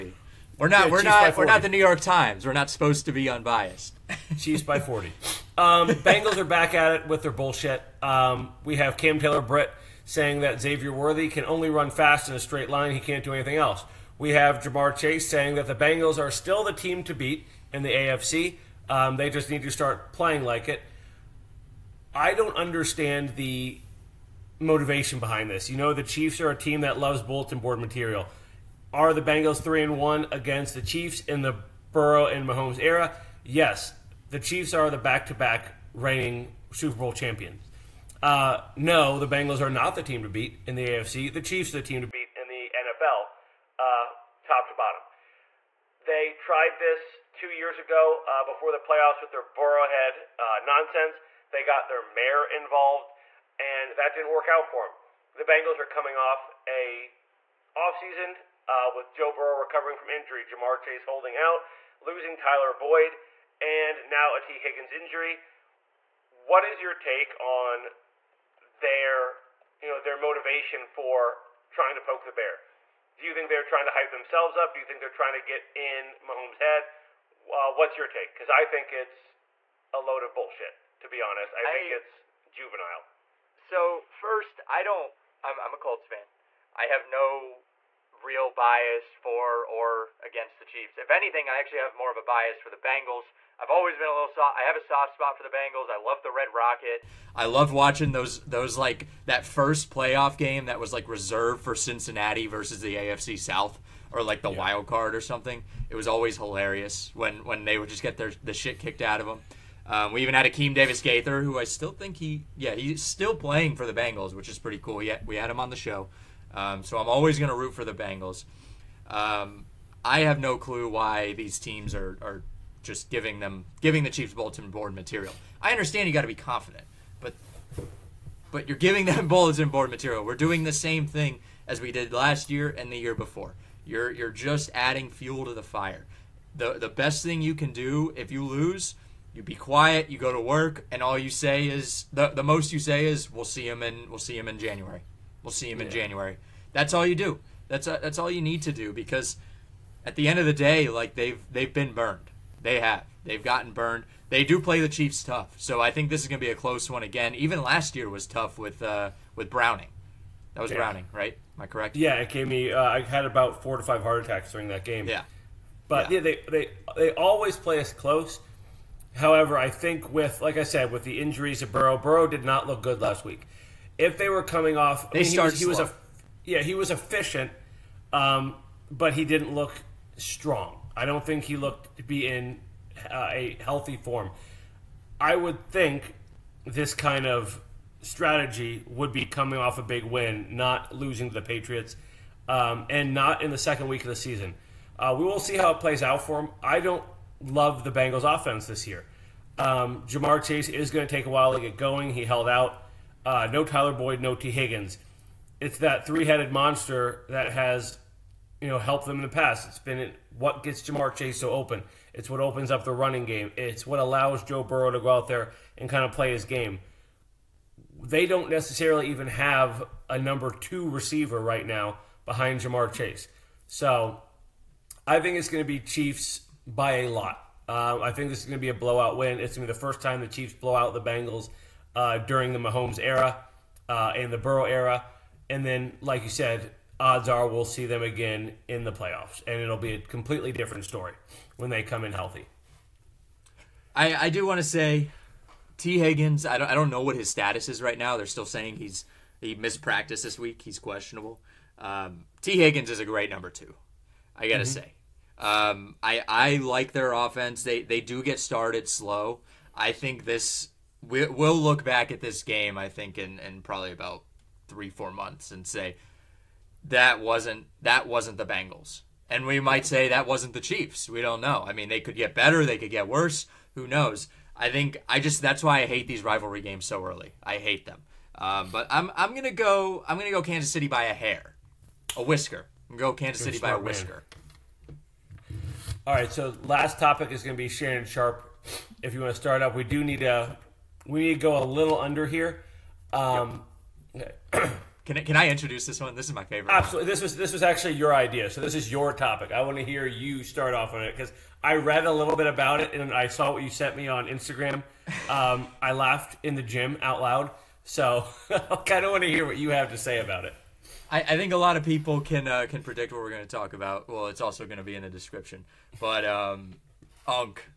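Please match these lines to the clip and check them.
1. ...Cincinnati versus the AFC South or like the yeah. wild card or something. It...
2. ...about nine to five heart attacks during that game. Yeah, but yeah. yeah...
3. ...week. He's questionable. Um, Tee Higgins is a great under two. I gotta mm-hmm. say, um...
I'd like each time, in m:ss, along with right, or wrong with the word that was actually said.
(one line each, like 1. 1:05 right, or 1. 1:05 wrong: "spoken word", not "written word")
1. 1:41 right
2. 2:43 wrong: "four", not "nine"
3. 4:10 wrong: "number", not "under".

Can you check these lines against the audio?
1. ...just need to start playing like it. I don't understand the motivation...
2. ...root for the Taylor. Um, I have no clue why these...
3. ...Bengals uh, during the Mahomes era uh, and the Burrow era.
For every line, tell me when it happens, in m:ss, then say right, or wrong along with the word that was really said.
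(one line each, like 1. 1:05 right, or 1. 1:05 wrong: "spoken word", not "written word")
1. 0:19 right
2. 1:57 wrong: "Bengals", not "Taylor"
3. 3:50 right.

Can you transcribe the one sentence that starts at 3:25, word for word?
It's that three-headed monster that has, you know, helped them in the past.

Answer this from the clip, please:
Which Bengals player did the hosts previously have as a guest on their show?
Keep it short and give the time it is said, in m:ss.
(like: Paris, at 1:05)
Akeem Davis Gaither, at 1:50.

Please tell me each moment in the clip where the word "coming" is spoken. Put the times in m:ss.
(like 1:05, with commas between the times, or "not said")
0:55, 2:54, 3:09.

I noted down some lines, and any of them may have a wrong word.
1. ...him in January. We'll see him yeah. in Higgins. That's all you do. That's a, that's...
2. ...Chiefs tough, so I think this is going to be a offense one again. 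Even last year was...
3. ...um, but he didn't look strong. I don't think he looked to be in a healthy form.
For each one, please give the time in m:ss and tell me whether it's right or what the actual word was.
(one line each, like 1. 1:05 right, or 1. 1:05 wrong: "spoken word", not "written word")
1. 2:24 wrong: "January", not "Higgins"
2. 2:34 wrong: "close", not "offense"
3. 2:58 right.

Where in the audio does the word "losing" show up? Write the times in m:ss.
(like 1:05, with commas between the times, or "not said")
1:01, 3:10.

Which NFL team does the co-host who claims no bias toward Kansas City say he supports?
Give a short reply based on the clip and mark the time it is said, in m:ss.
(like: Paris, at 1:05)
Colts, at 1:25.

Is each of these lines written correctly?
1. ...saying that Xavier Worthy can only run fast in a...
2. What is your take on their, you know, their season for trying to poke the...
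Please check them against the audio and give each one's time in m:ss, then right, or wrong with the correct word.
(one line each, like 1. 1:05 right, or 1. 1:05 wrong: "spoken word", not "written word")
1. 0:10 right
2. 1:06 wrong: "motivation", not "season".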